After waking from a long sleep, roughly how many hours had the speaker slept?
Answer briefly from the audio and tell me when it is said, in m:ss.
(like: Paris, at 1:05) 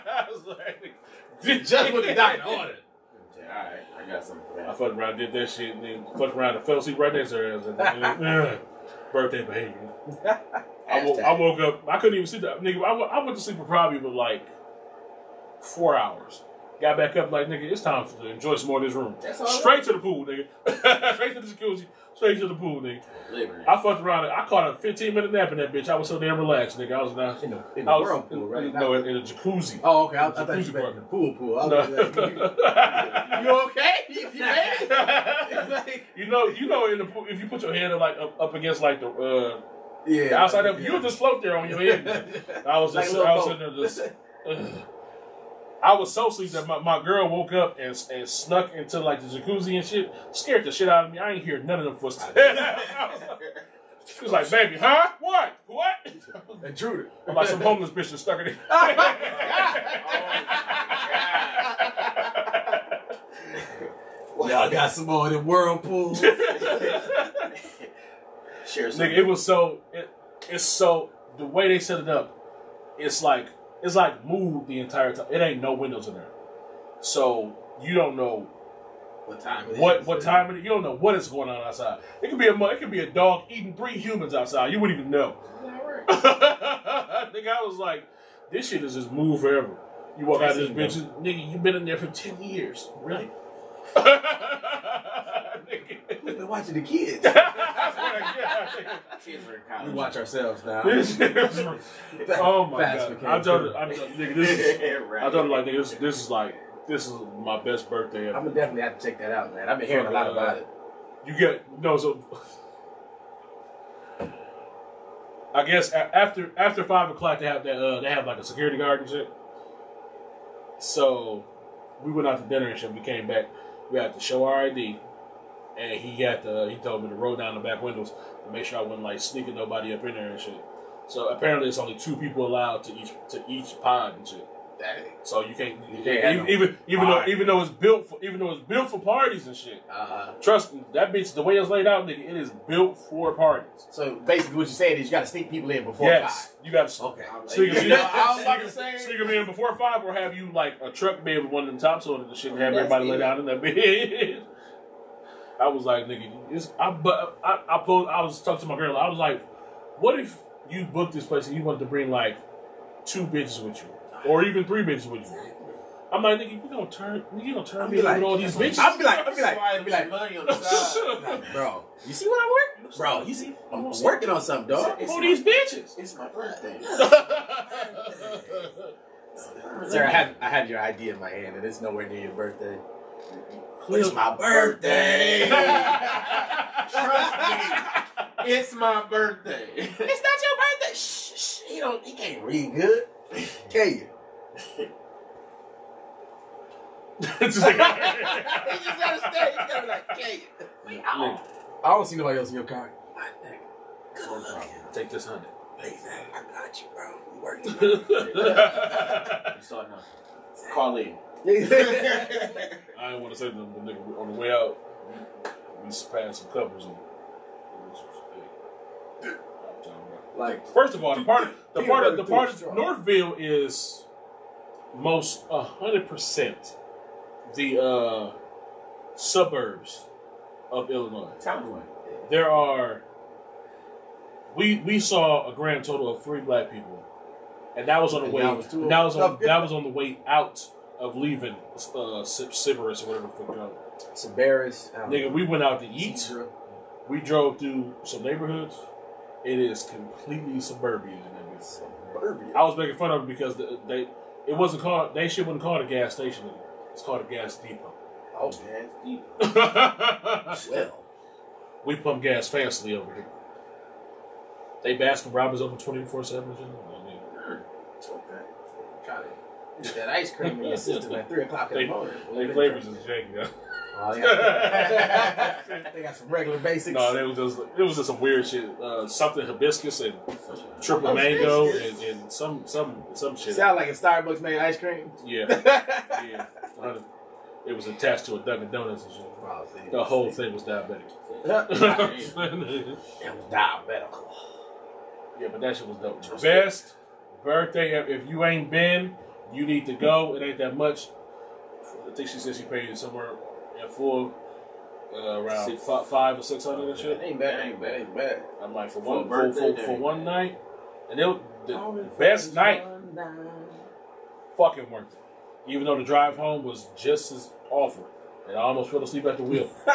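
4 hours, at 0:15.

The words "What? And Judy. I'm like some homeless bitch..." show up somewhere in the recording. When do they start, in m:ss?
0:55.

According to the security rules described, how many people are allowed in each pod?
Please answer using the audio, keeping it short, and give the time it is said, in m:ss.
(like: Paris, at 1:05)
2, at 2:11.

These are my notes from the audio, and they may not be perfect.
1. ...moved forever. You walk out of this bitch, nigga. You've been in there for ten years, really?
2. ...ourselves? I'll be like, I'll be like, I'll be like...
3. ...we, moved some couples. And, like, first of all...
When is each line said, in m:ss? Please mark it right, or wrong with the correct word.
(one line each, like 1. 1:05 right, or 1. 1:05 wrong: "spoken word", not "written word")
1. 1:29 right
2. 2:48 wrong: "bitches", not "ourselves"
3. 3:35 wrong: "passed", not "moved".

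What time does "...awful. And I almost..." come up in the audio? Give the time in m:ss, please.
5:17.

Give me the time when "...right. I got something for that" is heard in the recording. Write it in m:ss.
0:03.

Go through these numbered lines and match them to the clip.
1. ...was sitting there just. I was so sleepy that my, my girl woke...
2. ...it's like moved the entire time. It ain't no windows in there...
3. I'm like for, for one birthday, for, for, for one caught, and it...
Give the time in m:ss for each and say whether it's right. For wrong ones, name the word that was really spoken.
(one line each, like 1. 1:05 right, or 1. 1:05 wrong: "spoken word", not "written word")
1. 0:43 right
2. 1:13 right
3. 5:08 wrong: "night", not "caught".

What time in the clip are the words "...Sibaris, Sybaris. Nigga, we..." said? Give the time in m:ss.
4:04.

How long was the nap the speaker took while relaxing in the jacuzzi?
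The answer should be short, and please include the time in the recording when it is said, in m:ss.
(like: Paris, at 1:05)
15 minutes, at 0:24.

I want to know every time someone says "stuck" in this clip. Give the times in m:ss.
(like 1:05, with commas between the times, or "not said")
0:58.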